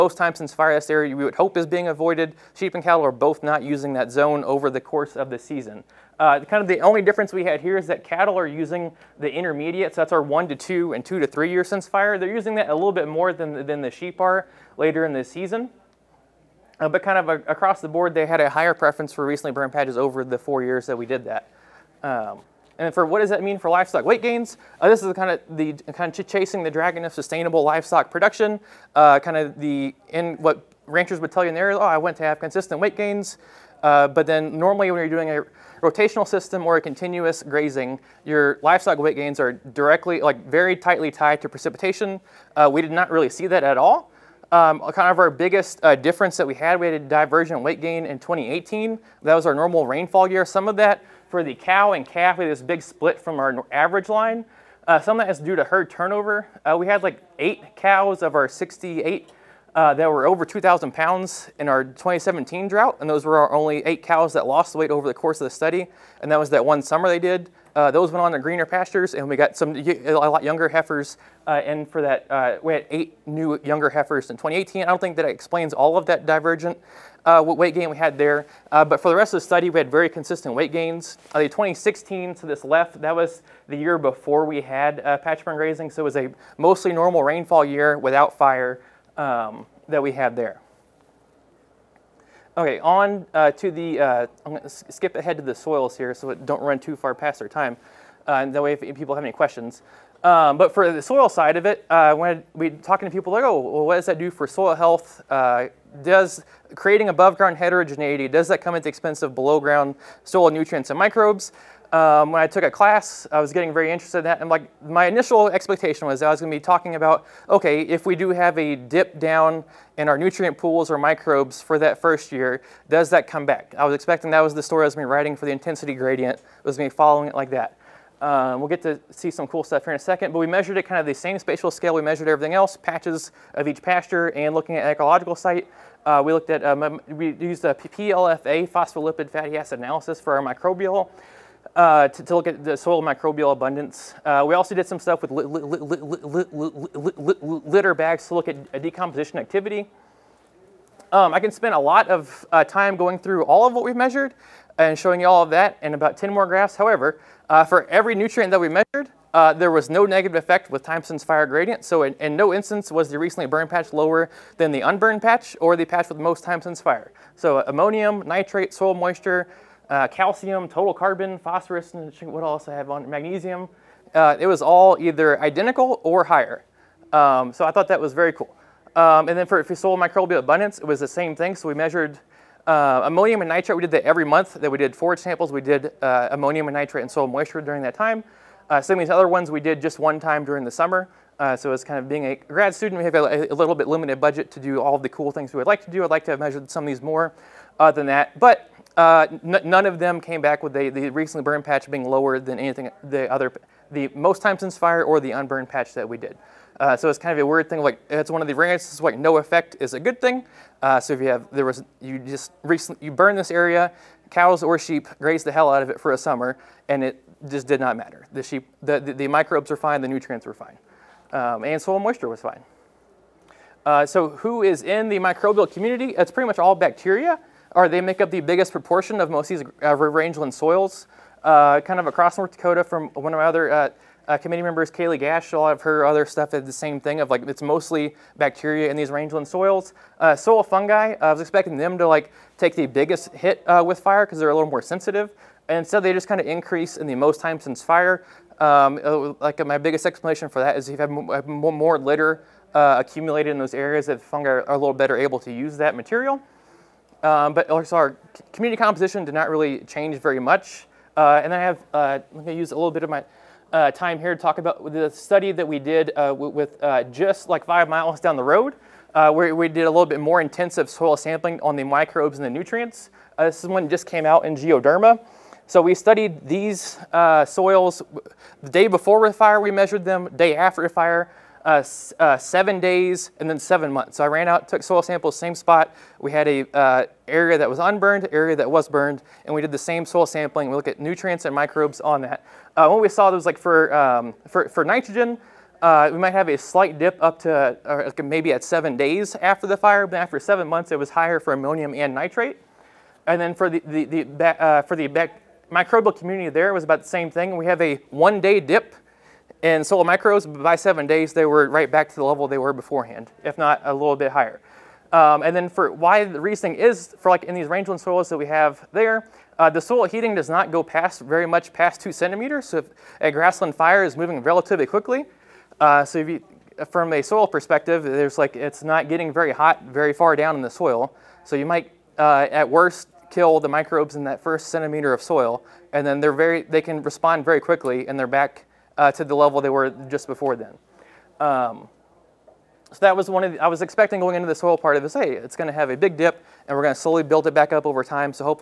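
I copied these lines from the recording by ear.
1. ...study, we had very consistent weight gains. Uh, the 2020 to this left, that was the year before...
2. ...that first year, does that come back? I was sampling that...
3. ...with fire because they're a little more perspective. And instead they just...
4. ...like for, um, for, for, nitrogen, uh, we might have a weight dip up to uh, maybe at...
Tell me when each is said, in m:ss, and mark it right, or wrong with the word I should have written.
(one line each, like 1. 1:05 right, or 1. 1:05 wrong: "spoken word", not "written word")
1. 1:19 wrong: "2016", not "2020"
2. 2:01 wrong: "expecting", not "sampling"
3. 4:03 wrong: "sensitive", not "perspective"
4. 4:53 wrong: "slight", not "weight".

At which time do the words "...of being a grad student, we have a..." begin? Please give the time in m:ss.
3:11.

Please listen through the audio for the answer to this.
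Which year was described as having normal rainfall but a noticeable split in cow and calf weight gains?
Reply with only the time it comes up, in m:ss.
0:48.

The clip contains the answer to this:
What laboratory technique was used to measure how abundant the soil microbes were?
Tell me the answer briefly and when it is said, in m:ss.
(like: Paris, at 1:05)
phospholipid fatty acid analysis, at 2:18.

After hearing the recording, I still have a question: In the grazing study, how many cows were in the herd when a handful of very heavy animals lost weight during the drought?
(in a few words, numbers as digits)
68.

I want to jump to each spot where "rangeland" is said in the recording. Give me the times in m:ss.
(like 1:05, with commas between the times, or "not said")
3:50, 3:59, 5:17.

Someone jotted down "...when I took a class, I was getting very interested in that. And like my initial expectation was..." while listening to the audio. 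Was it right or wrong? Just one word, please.
right.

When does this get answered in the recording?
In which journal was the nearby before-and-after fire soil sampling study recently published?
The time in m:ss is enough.
4:34.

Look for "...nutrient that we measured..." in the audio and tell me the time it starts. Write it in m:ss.
2:38.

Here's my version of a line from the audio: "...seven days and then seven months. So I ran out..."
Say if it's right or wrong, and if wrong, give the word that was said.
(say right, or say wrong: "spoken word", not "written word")
right.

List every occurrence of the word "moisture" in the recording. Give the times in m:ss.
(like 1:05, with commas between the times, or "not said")
2:48, 3:07, 3:41.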